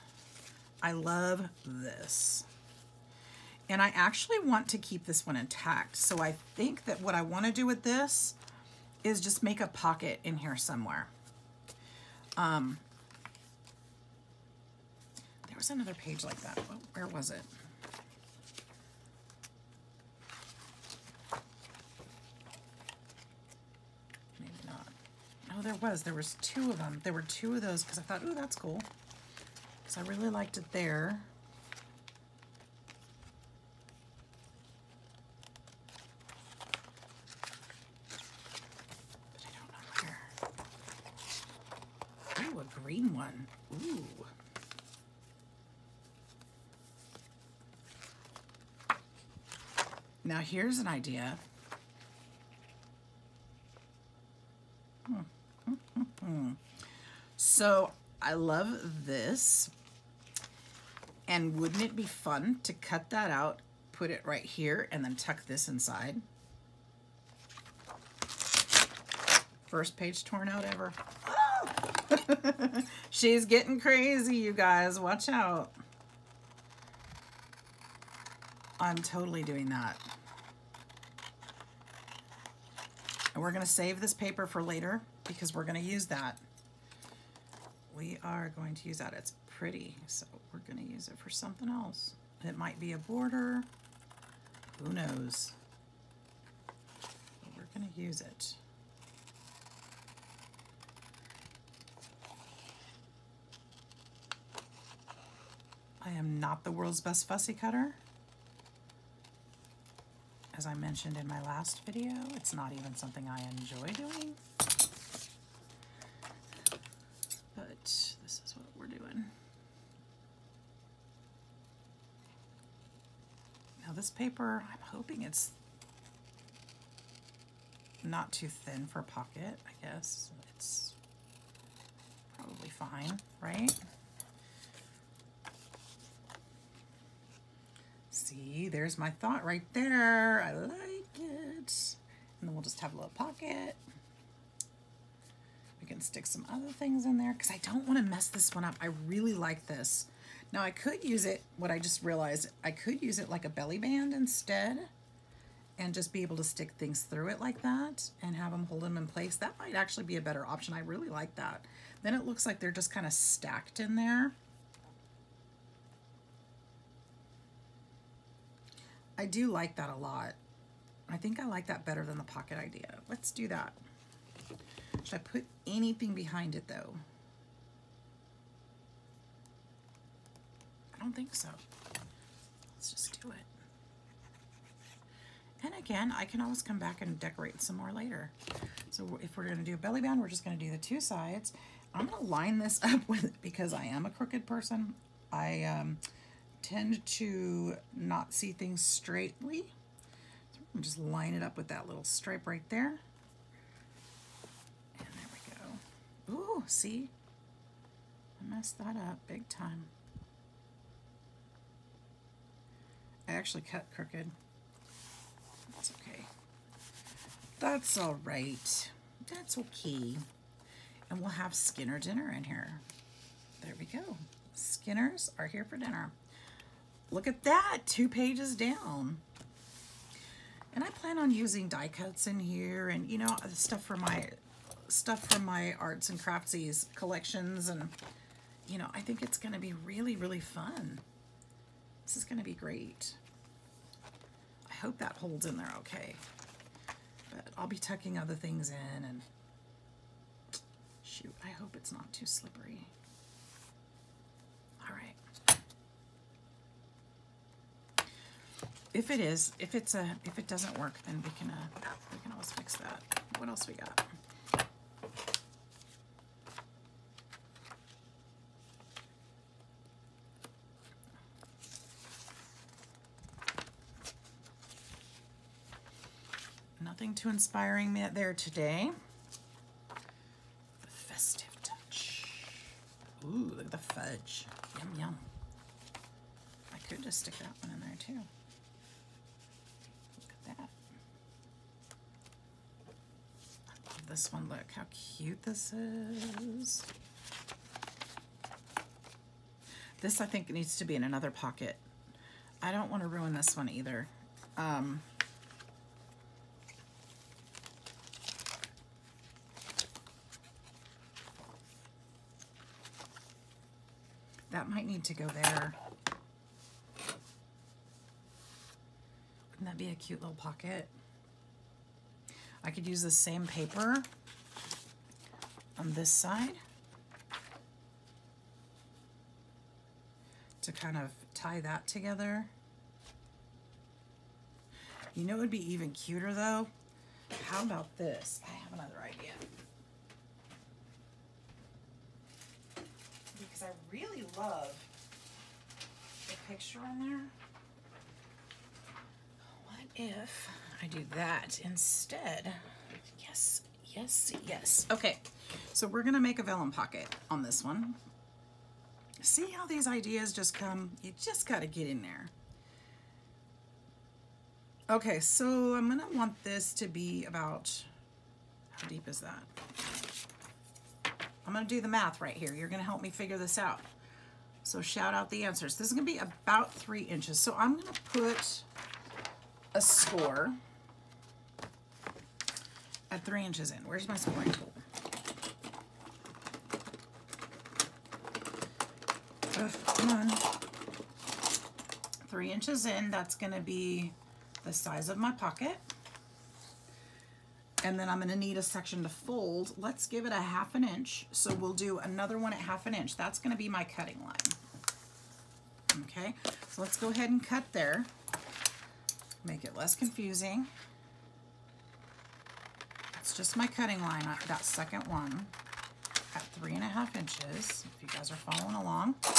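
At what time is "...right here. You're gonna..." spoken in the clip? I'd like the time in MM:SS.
06:12.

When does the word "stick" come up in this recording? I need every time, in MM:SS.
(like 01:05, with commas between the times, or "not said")
02:25, 02:36, 04:47.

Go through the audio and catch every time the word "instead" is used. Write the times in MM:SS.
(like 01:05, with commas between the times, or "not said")
02:34, 05:51.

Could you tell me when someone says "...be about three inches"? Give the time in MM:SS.
06:16.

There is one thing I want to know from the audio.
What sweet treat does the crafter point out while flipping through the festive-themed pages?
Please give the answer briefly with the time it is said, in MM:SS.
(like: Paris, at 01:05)
fudge, at 04:43.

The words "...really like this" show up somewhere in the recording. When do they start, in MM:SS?
02:28.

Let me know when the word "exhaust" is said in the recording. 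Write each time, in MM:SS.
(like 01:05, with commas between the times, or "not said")
not said.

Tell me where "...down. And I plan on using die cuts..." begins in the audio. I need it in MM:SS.
03:48.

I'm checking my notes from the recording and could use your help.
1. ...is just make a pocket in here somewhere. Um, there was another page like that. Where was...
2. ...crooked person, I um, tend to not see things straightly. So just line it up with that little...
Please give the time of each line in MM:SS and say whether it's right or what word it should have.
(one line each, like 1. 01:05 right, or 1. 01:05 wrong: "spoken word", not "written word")
1. 00:09 right
2. 03:14 right.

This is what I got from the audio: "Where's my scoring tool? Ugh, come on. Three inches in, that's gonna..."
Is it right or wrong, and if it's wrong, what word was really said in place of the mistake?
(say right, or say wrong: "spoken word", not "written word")
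right.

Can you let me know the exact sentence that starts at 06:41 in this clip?
So we'll do another one at half an inch.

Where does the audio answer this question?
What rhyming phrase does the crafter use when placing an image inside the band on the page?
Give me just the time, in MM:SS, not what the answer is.
03:41.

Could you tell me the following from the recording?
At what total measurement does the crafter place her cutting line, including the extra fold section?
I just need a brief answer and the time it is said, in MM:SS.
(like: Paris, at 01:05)
3 and a half inches, at 06:56.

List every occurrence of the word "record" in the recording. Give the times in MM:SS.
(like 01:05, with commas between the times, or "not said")
not said.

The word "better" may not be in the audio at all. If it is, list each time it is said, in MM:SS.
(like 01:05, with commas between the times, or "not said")
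02:40, 02:51.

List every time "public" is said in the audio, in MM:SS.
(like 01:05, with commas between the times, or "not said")
not said.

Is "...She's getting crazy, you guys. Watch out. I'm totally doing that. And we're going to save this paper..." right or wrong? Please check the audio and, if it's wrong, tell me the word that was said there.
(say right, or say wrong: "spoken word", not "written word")
right.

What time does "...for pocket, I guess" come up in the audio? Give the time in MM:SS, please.
02:08.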